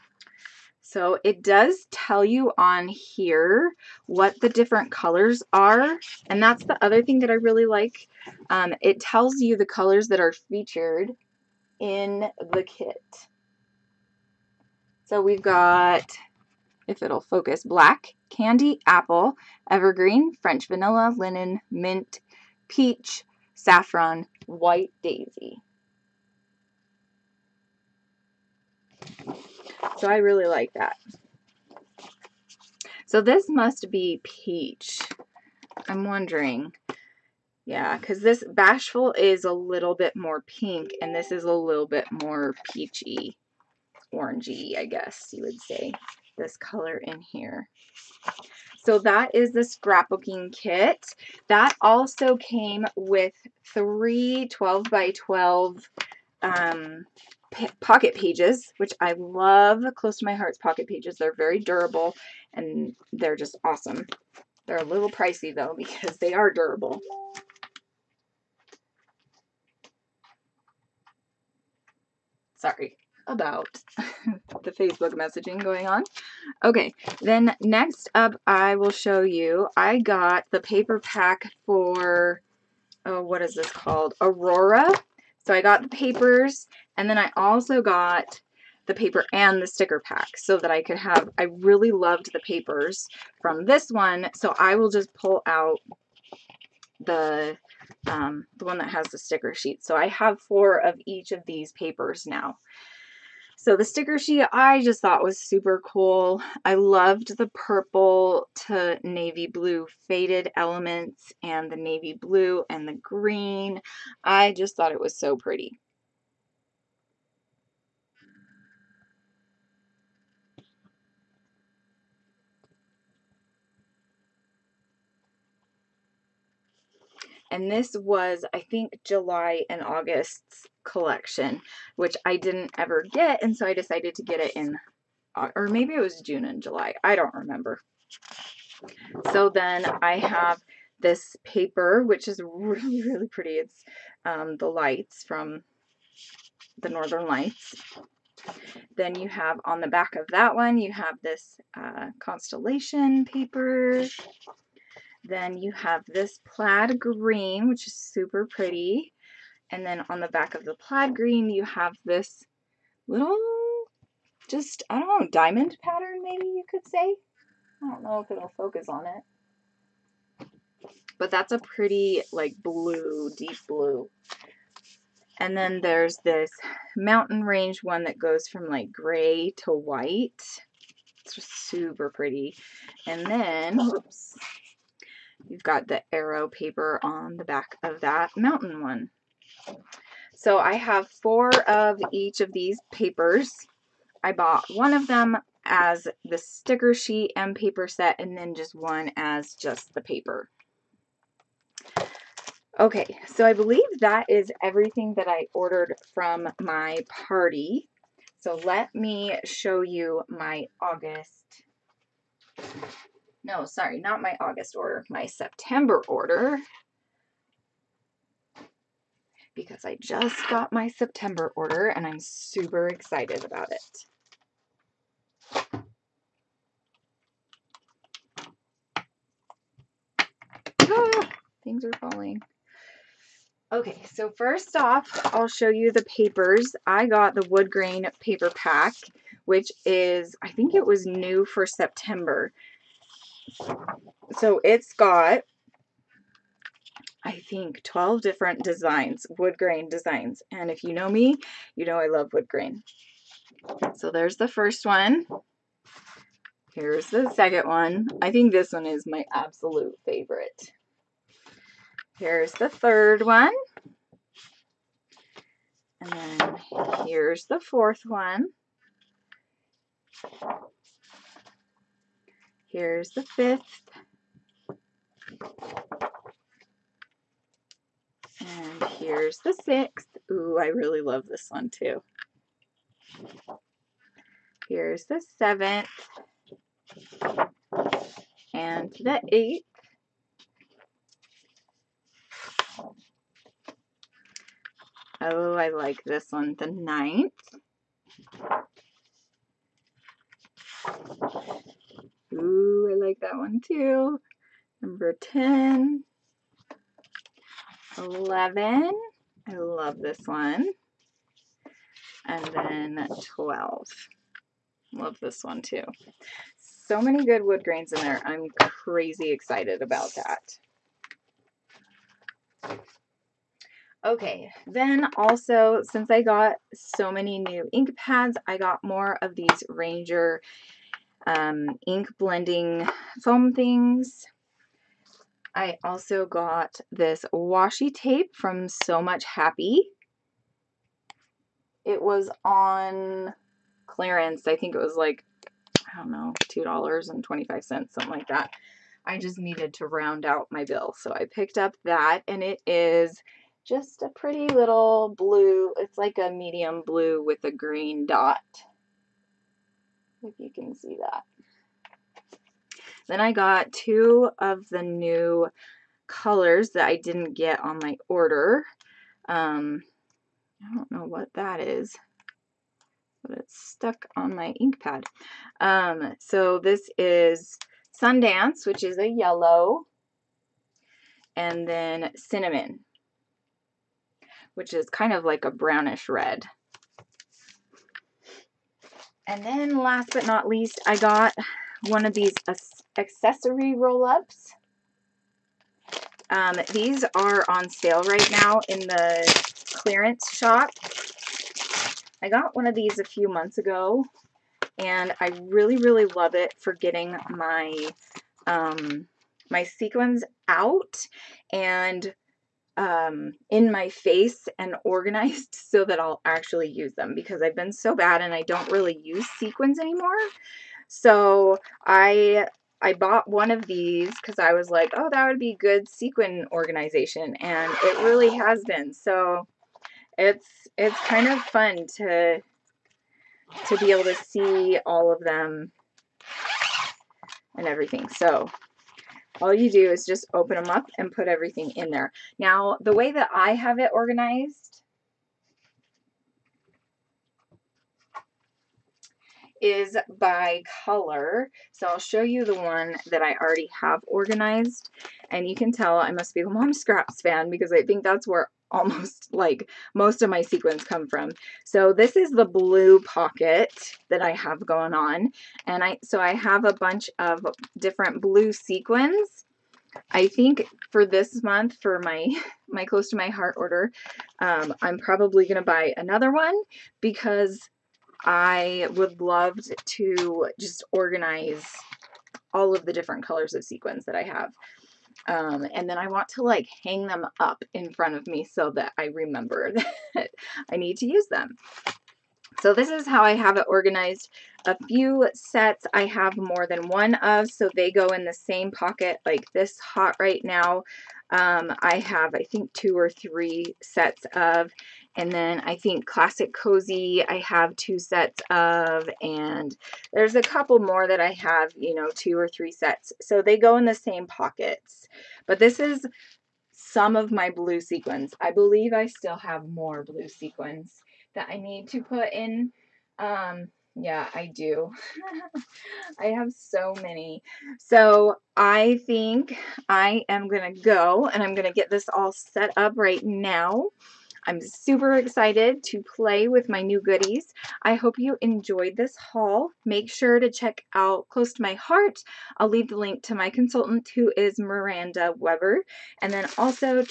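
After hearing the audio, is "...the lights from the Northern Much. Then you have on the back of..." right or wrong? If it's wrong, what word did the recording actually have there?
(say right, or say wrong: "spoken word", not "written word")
wrong: "Lights", not "Much".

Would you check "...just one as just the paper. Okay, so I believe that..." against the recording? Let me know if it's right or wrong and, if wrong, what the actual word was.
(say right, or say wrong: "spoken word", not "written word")
right.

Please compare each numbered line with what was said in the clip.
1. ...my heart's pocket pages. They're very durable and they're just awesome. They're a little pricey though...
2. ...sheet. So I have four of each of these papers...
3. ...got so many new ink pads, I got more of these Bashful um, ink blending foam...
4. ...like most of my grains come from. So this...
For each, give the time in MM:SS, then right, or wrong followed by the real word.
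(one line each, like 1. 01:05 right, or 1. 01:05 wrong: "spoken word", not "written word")
1. 01:00 right
2. 01:39 right
3. 05:26 wrong: "Ranger", not "Bashful"
4. 07:39 wrong: "sequins", not "grains".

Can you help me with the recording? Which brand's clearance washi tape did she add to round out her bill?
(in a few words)
So Much Happy.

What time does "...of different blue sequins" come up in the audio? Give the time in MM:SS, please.
07:47.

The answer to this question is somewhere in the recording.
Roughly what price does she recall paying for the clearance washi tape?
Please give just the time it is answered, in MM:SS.
05:46.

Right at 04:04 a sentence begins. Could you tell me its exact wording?
So it's got I think 12 different designs, wood grain designs.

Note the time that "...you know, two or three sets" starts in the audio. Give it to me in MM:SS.
08:31.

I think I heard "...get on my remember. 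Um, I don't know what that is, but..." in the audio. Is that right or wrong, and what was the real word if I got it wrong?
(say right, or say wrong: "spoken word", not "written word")
wrong: "order", not "remember".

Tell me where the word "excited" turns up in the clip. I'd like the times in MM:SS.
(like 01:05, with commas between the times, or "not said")
03:42, 05:19, 08:55.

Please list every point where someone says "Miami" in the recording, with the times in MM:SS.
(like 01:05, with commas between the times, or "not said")
not said.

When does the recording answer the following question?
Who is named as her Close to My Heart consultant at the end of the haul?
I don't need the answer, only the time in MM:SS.
09:04.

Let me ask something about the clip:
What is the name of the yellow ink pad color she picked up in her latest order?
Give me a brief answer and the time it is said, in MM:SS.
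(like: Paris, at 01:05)
Sundance, at 06:18.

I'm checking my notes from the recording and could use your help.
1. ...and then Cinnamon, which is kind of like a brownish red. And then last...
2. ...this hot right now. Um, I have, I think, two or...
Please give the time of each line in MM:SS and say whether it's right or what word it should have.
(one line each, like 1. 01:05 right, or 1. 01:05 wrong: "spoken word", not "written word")
1. 06:21 right
2. 08:19 right.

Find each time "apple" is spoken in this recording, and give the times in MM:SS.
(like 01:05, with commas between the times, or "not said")
00:18.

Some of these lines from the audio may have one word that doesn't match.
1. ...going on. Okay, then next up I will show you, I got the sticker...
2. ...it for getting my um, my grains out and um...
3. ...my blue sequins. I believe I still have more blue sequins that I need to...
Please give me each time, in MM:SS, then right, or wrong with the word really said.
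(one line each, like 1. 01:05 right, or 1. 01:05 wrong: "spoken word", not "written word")
1. 01:15 wrong: "paper", not "sticker"
2. 06:46 wrong: "sequins", not "grains"
3. 08:37 right.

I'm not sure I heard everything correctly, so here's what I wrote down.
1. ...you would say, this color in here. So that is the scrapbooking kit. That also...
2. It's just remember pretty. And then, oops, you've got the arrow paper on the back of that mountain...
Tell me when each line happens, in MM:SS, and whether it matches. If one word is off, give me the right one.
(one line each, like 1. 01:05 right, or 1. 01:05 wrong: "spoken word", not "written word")
1. 00:45 right
2. 03:01 wrong: "super", not "remember".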